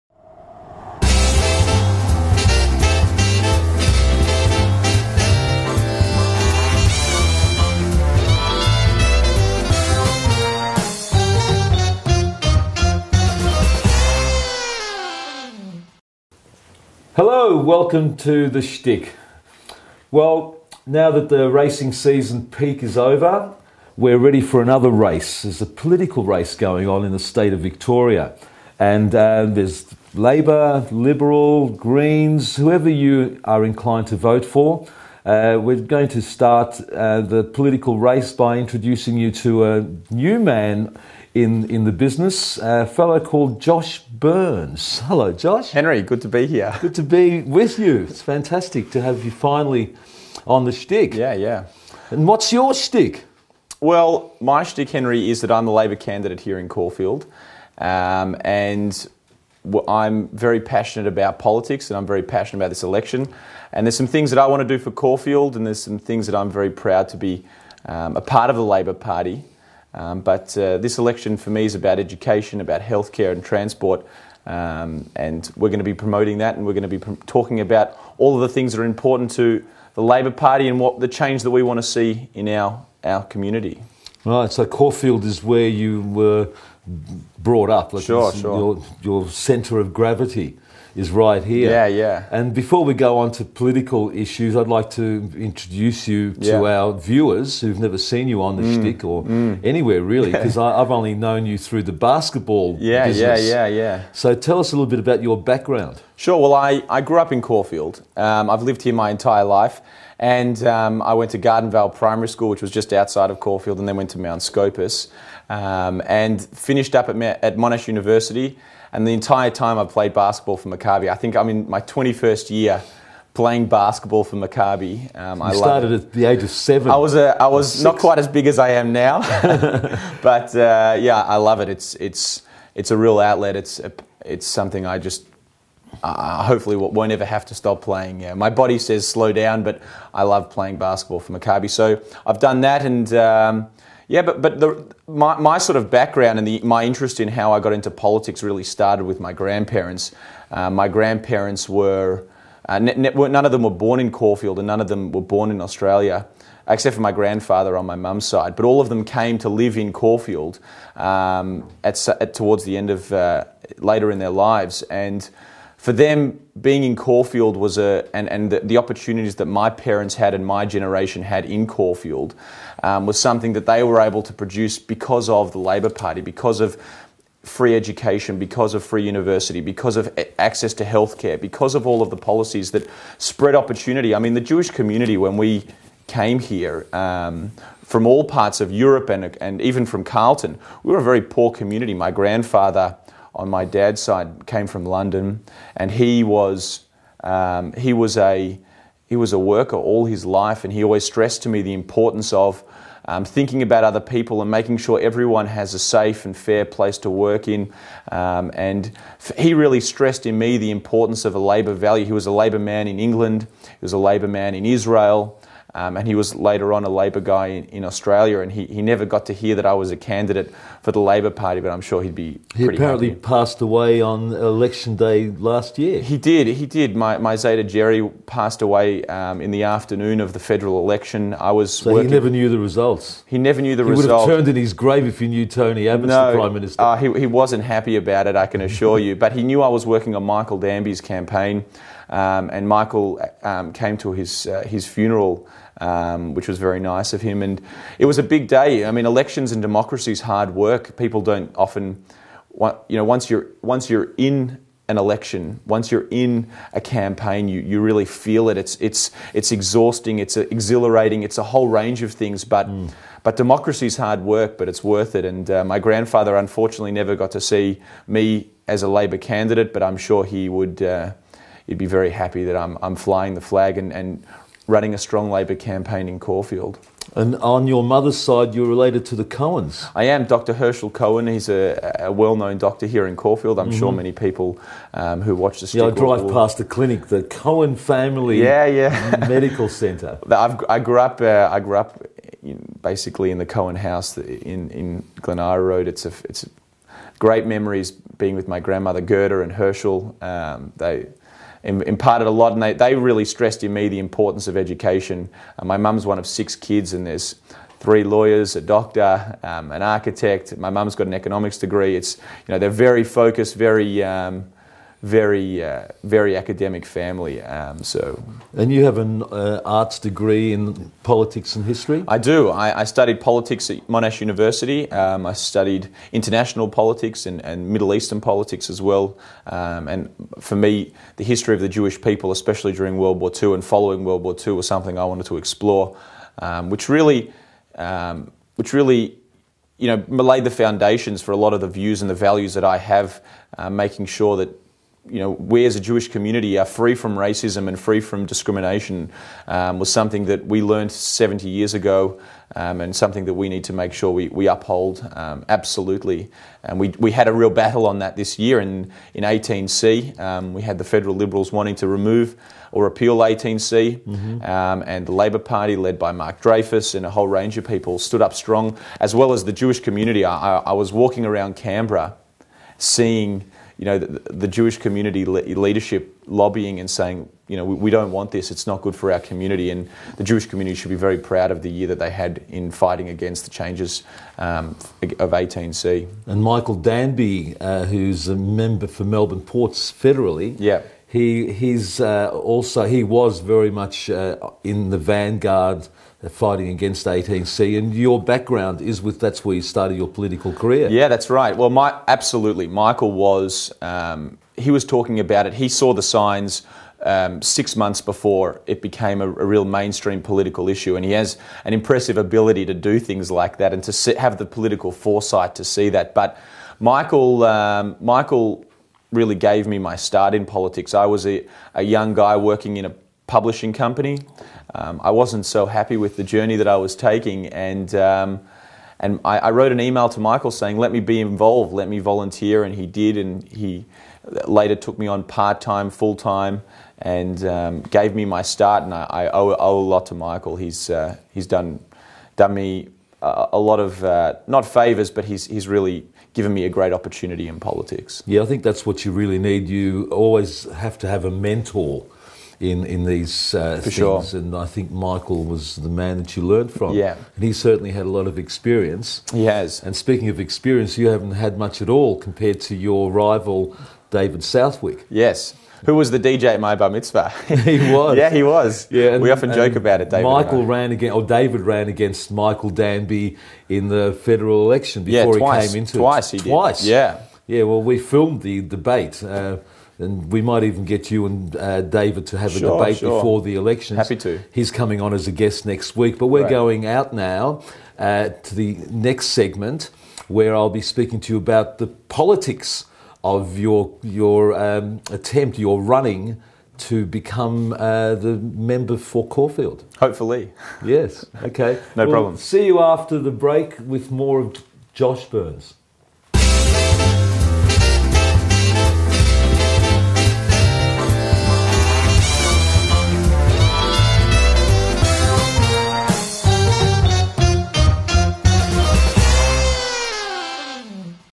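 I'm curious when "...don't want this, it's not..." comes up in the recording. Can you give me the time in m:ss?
6:17.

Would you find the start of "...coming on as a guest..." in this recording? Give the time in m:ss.
8:04.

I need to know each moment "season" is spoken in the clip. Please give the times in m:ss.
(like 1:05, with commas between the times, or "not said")
0:21.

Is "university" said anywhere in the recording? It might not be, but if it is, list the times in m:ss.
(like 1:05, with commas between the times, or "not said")
1:57, 2:59, 5:24.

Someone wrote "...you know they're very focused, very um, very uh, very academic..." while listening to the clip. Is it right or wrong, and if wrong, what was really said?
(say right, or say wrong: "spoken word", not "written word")
right.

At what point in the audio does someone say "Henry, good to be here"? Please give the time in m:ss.
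0:45.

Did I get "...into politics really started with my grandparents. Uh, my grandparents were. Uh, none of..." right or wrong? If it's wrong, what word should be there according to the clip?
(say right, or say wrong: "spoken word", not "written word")
right.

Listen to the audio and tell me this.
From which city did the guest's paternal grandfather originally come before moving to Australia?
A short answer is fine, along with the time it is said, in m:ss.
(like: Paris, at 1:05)
London, at 3:14.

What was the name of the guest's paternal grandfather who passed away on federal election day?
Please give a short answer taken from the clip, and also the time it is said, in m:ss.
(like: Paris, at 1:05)
Jerry, at 3:47.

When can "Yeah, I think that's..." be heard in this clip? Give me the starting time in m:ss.
7:28.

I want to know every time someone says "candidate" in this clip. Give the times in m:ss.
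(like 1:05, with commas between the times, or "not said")
0:55, 3:39, 4:29.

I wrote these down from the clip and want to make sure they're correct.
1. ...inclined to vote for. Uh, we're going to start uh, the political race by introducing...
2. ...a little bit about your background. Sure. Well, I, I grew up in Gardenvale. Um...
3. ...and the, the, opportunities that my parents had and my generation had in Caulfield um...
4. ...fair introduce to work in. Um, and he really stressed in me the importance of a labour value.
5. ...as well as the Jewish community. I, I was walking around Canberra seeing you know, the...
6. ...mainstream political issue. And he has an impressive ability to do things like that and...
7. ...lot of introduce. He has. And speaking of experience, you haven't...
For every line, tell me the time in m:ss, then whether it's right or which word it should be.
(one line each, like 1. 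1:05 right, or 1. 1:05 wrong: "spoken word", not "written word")
1. 0:33 right
2. 1:44 wrong: "Caulfield", not "Gardenvale"
3. 2:48 right
4. 3:26 wrong: "place", not "introduce"
5. 6:09 right
6. 6:49 right
7. 7:38 wrong: "experience", not "introduce".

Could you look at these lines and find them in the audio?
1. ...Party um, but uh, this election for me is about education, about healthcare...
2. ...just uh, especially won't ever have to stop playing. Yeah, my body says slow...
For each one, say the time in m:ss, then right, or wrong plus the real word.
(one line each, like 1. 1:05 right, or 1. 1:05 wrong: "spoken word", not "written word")
1. 1:08 right
2. 2:14 wrong: "hopefully", not "especially".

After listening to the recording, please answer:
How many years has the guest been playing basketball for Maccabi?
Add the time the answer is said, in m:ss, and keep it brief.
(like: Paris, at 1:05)
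21, at 2:01.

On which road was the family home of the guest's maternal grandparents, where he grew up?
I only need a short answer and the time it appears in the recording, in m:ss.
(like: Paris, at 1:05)
Glen Eira Road, at 4:55.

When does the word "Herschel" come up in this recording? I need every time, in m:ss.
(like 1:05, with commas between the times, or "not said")
4:40, 4:59.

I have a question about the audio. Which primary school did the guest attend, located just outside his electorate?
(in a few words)
Gardenvale Primary School.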